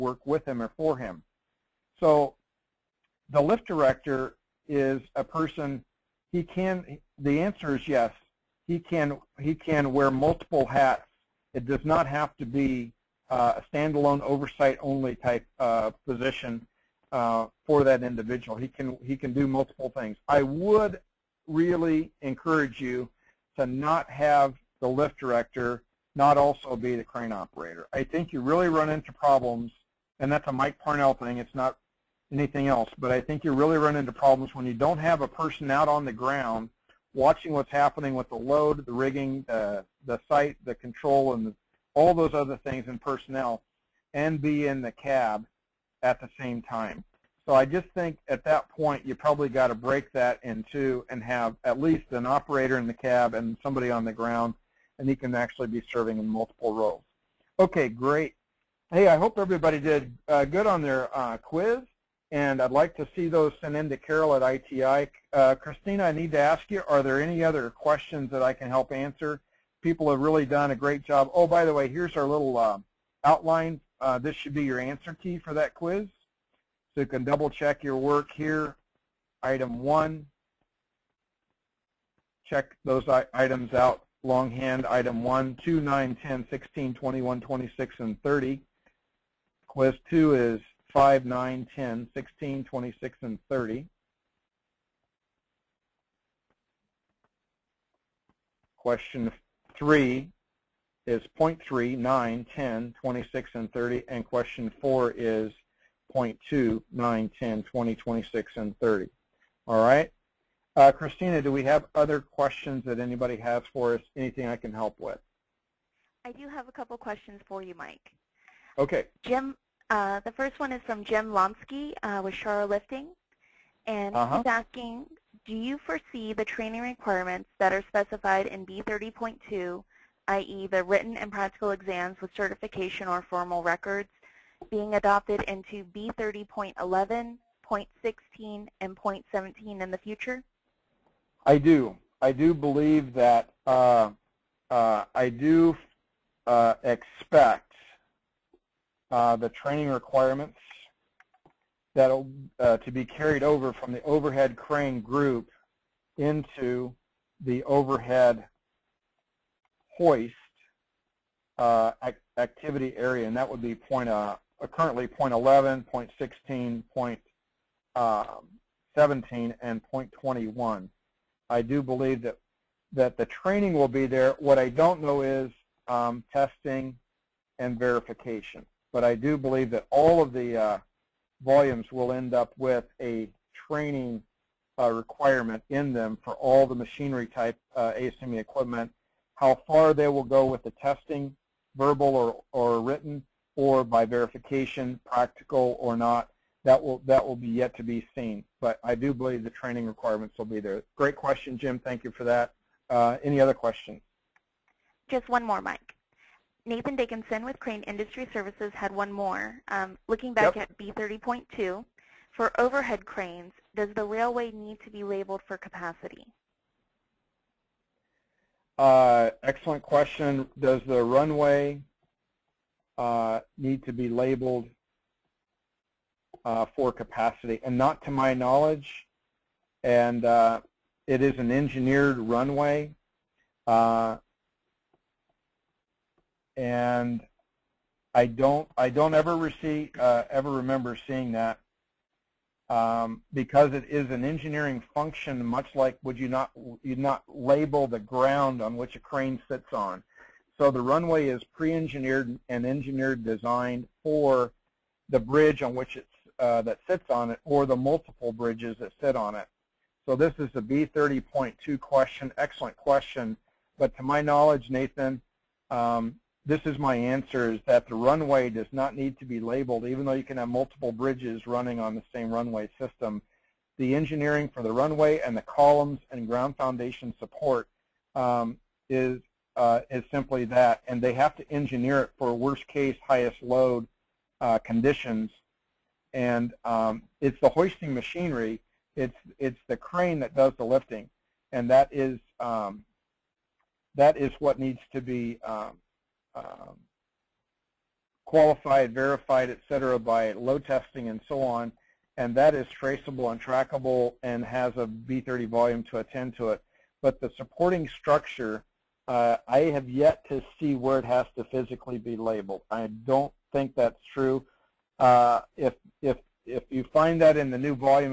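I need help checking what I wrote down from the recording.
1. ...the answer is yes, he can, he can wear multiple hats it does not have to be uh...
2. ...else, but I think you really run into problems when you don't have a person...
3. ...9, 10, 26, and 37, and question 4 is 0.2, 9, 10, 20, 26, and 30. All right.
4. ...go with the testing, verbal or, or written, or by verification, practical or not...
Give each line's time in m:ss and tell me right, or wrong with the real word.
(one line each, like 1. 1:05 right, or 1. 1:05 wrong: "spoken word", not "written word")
1. 0:07 right
2. 0:32 right
3. 1:41 wrong: "30", not "37"
4. 3:10 right.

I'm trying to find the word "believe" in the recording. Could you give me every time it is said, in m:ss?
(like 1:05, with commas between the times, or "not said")
2:22, 2:51, 2:59, 3:19.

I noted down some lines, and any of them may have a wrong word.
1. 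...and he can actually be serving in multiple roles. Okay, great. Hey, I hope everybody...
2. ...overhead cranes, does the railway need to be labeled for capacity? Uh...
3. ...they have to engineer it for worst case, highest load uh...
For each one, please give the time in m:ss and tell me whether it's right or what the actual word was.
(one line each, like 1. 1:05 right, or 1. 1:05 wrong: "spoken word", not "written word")
1. 0:54 right
2. 3:32 right
3. 4:41 right.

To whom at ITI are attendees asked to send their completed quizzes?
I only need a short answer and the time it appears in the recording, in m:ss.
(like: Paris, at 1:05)
Carol, at 1:03.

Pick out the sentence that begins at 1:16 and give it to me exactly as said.
So you can double check your work here.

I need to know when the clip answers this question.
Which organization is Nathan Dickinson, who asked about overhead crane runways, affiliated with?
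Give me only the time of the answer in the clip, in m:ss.
3:27.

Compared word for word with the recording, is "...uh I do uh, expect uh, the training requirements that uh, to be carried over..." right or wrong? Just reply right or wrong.
right.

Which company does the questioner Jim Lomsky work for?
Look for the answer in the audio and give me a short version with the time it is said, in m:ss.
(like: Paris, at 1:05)
Shara Lifting, at 2:02.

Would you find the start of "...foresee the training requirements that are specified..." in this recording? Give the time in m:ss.
2:05.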